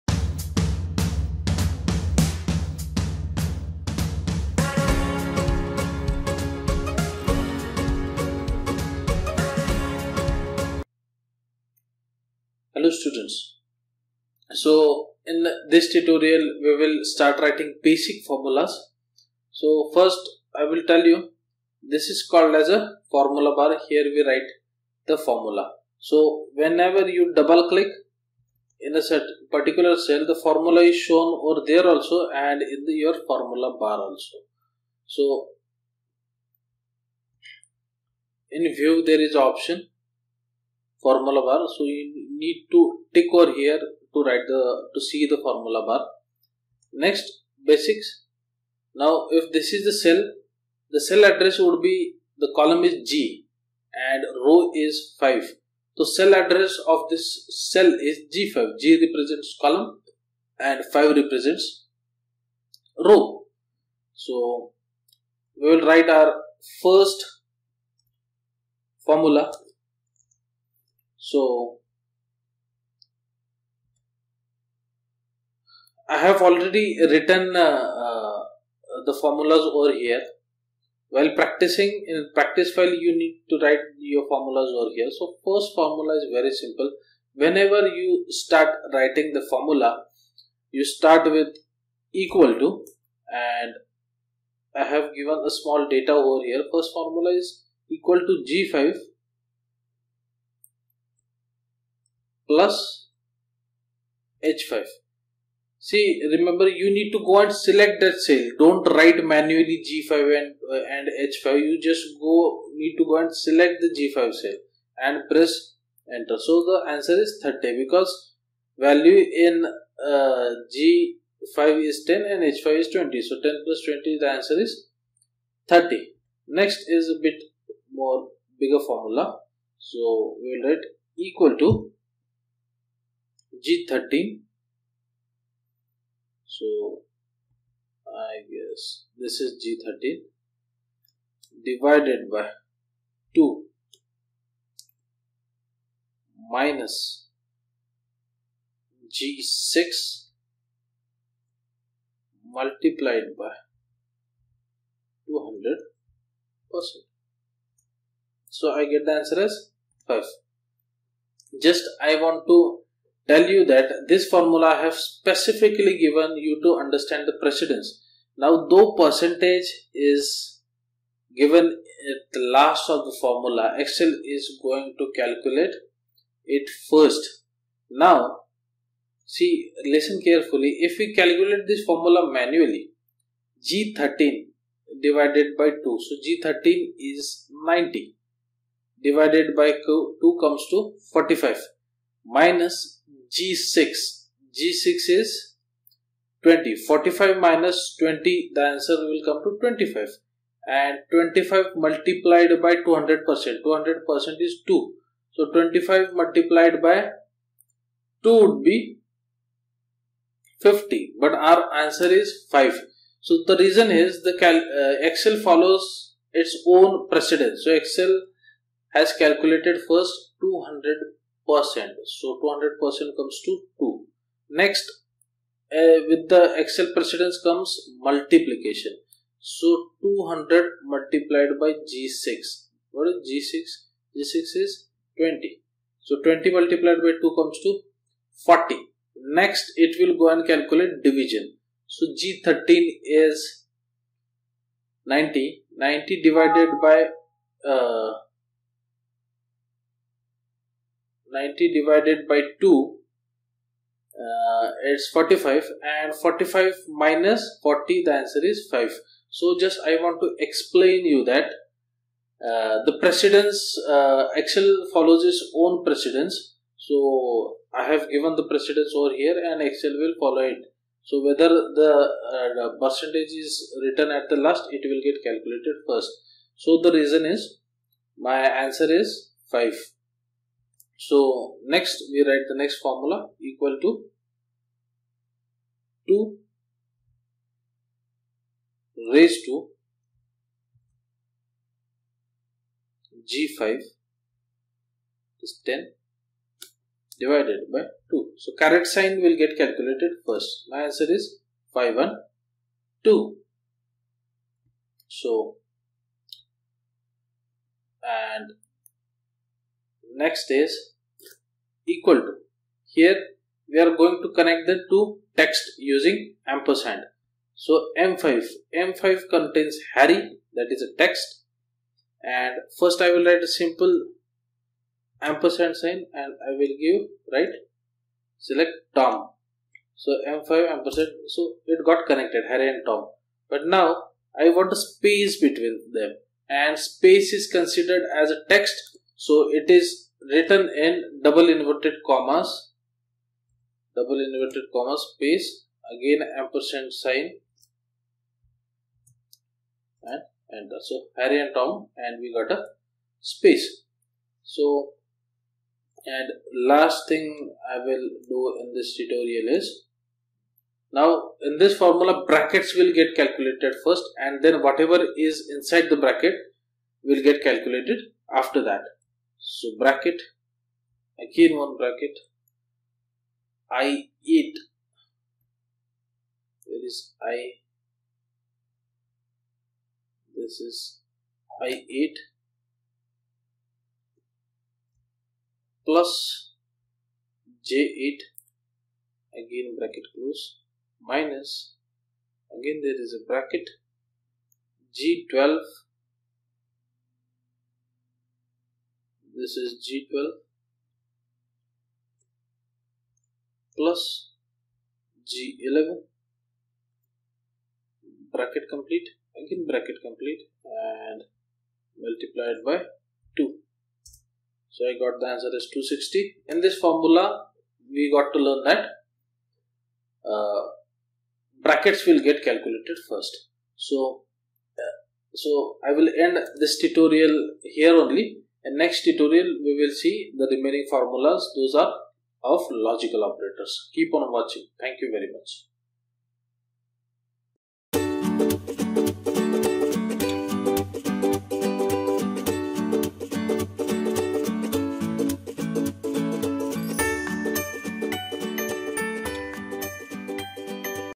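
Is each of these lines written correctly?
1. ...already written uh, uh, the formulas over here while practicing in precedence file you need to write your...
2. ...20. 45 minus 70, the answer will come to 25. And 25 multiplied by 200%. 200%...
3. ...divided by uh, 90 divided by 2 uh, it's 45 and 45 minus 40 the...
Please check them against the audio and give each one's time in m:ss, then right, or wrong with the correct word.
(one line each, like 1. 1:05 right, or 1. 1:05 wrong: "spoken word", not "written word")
1. 1:16 wrong: "practice", not "precedence"
2. 3:16 wrong: "20", not "70"
3. 4:06 right.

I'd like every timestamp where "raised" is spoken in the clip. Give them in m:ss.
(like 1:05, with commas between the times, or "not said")
4:49.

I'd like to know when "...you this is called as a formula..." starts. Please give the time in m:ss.
0:21.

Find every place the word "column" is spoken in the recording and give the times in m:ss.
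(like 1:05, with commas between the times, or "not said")
0:52, 0:59.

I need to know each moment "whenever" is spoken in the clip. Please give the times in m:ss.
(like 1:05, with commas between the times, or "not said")
0:26, 1:27.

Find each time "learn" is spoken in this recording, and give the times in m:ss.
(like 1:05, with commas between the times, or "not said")
6:58.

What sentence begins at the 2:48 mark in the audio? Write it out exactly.
Now though percentage is given at the last of the formula, Excel is going to calculate it first.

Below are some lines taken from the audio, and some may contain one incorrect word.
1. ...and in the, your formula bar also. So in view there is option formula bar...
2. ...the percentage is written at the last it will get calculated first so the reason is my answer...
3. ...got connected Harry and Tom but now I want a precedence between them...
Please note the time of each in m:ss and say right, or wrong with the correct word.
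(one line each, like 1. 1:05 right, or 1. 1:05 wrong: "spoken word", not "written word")
1. 0:32 right
2. 4:32 right
3. 5:31 wrong: "space", not "precedence".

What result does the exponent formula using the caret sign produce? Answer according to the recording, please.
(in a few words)
512.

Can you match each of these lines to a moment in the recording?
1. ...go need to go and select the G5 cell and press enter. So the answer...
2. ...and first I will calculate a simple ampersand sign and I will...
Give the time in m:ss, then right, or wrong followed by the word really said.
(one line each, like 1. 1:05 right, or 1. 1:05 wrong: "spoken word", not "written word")
1. 1:52 right
2. 5:22 wrong: "write", not "calculate".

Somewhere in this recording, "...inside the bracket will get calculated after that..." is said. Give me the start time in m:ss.
6:05.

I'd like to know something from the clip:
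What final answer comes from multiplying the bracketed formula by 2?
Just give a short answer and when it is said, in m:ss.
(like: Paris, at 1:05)
260, at 6:55.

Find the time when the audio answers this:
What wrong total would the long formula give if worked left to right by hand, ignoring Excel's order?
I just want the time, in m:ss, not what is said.
3:28.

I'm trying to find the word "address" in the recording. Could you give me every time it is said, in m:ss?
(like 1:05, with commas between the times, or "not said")
0:51, 0:56.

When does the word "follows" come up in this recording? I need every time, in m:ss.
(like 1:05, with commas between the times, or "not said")
3:35, 4:24, 4:30.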